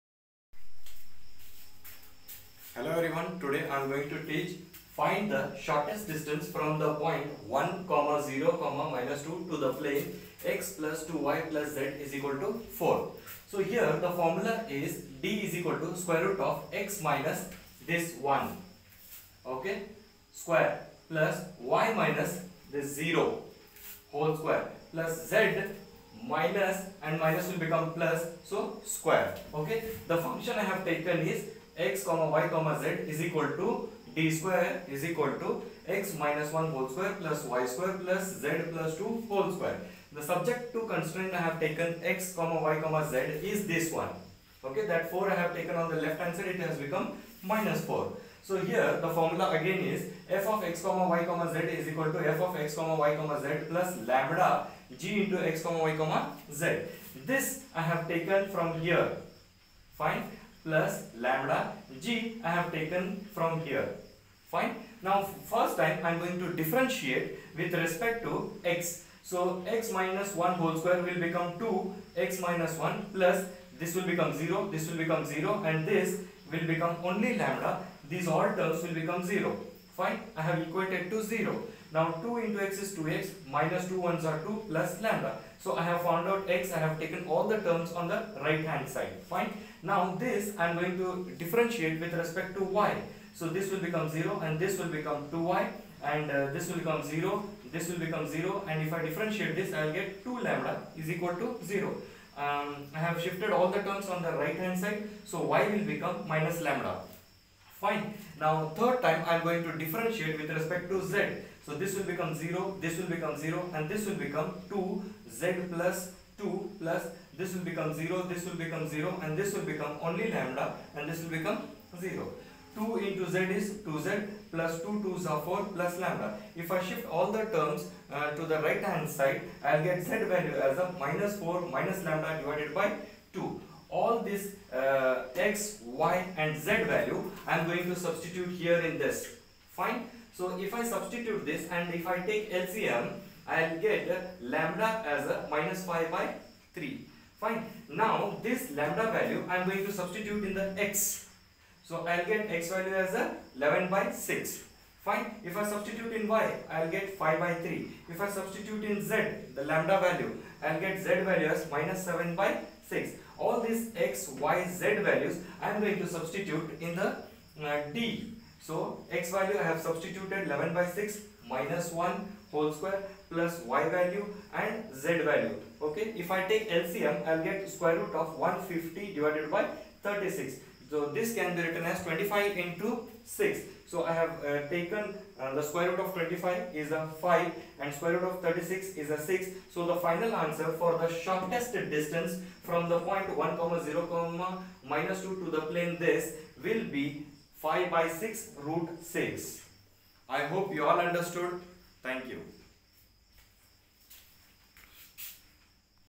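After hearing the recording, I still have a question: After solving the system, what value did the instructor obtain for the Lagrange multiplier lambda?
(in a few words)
-5/3.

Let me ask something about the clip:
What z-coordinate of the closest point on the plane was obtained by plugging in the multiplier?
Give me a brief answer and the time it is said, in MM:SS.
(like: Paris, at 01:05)
-7/6, at 02:41.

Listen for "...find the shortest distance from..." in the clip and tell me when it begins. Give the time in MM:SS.
00:04.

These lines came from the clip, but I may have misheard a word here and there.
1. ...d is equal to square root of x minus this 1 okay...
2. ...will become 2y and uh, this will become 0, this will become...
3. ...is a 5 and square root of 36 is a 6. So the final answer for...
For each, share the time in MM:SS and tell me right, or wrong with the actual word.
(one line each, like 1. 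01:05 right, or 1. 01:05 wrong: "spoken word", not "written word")
1. 00:15 right
2. 01:34 right
3. 03:06 right.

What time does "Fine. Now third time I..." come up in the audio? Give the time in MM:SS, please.
01:47.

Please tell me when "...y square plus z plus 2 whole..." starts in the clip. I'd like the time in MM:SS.
00:37.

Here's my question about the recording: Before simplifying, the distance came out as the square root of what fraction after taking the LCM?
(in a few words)
150/36.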